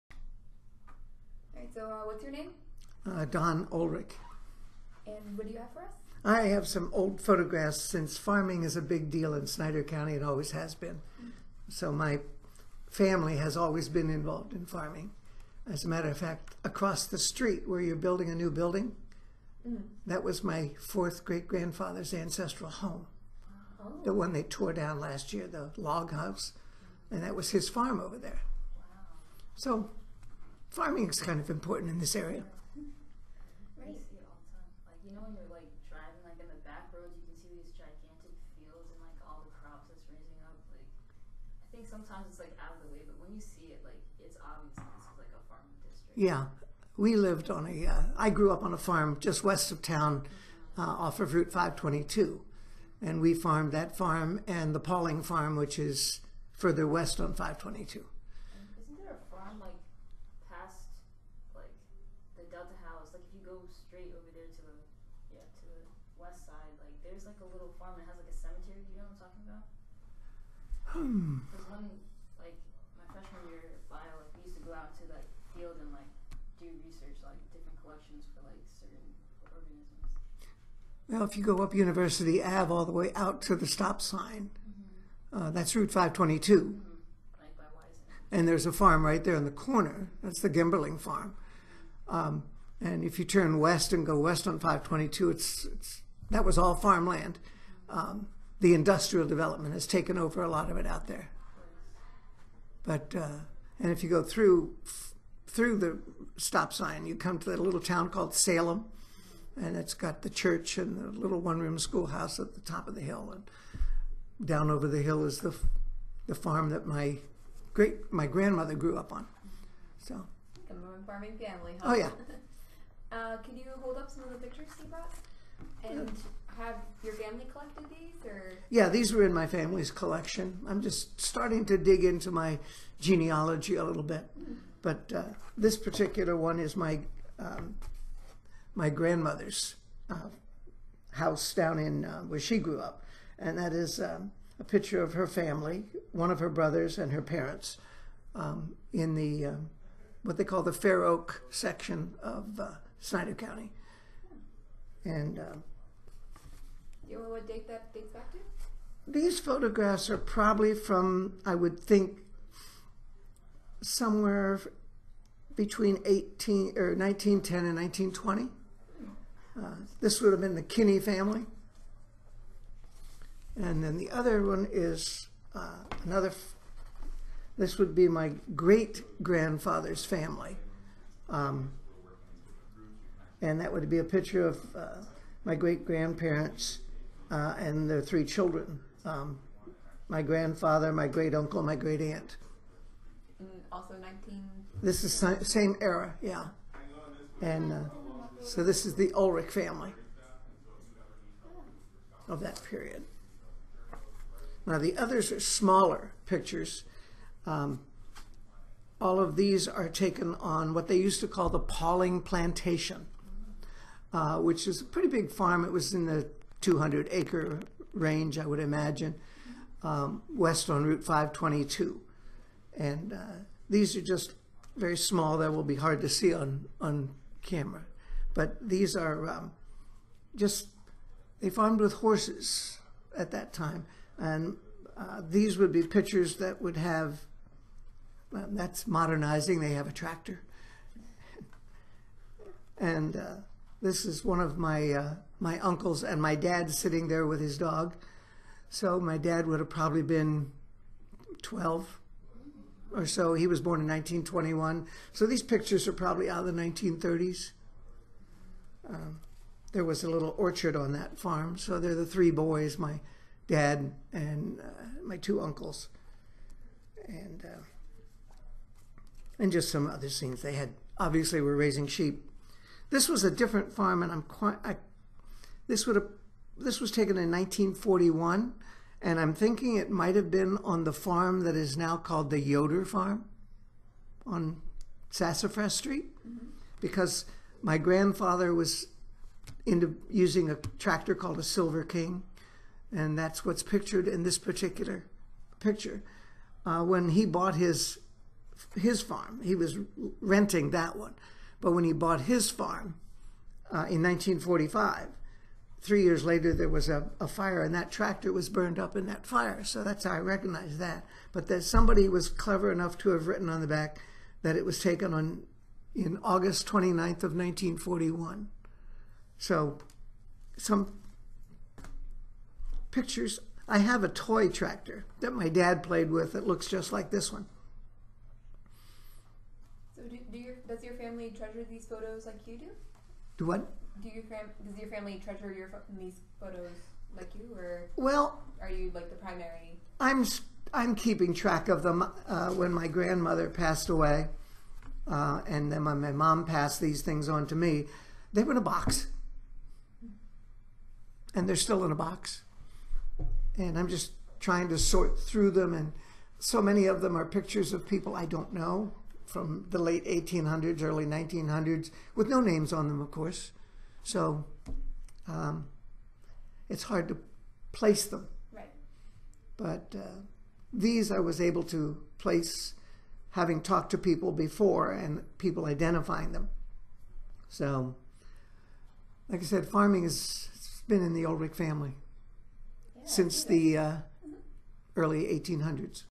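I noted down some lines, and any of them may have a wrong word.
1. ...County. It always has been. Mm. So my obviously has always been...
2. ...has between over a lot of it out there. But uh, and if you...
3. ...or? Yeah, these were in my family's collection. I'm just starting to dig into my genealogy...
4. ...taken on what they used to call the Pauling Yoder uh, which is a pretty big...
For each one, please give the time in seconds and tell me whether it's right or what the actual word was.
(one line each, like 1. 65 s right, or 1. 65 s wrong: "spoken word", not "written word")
1. 9 s wrong: "family", not "obviously"
2. 99 s wrong: "taken", not "between"
3. 128 s right
4. 209 s wrong: "Plantation", not "Yoder".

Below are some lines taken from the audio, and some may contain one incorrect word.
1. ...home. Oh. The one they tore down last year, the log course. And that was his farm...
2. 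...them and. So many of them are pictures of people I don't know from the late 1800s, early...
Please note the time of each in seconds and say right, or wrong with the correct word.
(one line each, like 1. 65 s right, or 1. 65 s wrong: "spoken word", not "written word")
1. 22 s wrong: "house", not "course"
2. 355 s right.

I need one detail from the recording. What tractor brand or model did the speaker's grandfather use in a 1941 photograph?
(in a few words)
Silver King.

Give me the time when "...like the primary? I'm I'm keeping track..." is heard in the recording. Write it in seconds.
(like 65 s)
338 s.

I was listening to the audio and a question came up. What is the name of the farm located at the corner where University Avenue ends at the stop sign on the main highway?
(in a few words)
Gimberling Farm.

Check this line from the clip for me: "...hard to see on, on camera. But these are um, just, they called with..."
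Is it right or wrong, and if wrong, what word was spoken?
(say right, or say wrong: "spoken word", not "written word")
wrong: "farmed", not "called".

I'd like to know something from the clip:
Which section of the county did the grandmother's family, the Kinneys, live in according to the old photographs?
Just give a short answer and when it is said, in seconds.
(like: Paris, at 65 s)
Fair Oak, at 150 s.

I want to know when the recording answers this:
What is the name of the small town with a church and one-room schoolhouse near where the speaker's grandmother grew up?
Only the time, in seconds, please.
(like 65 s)
108 s.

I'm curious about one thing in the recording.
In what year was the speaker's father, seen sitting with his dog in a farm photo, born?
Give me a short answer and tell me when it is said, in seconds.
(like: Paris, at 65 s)
1921, at 253 s.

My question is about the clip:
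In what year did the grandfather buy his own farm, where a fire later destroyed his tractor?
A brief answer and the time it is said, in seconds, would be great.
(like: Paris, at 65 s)
1945, at 304 s.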